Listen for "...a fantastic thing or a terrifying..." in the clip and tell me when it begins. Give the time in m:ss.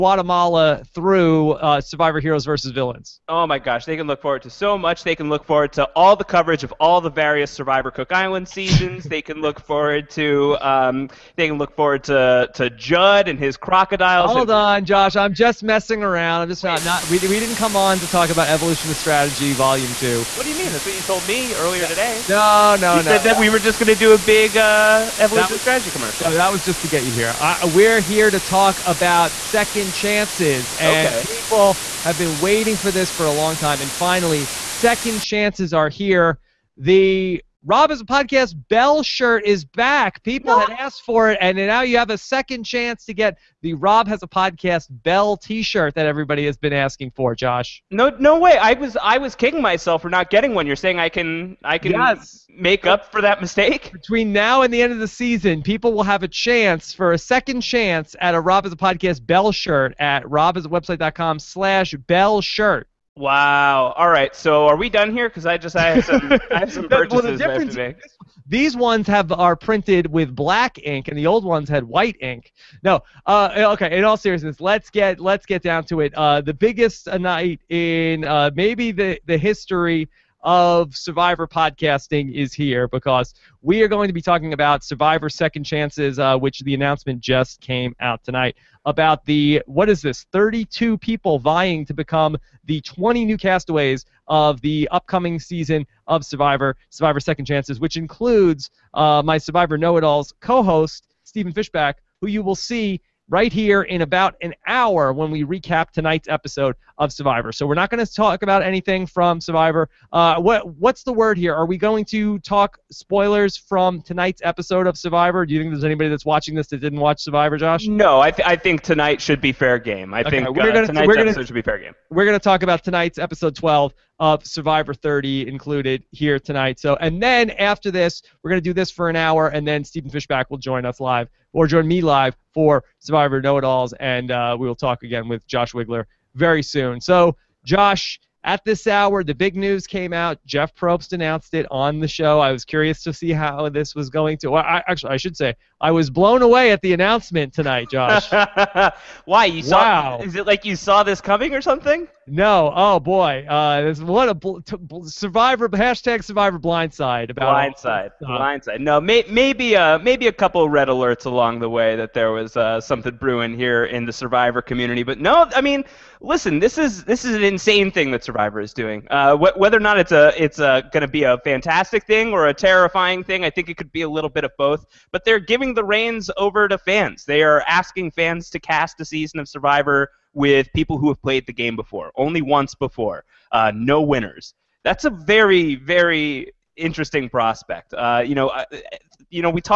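2:51.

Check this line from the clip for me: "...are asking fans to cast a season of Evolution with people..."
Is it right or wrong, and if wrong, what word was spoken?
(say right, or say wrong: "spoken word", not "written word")
wrong: "Survivor", not "Evolution".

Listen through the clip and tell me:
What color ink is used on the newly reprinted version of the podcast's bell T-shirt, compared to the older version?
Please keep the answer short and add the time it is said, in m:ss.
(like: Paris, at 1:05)
Black, at 1:10.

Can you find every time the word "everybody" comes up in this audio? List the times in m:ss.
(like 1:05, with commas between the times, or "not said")
0:46.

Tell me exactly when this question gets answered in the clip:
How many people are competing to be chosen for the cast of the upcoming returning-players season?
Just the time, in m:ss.
1:30.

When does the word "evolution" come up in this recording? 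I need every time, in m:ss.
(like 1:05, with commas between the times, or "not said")
0:18, 0:25.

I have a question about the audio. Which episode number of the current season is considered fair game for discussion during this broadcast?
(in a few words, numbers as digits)
12.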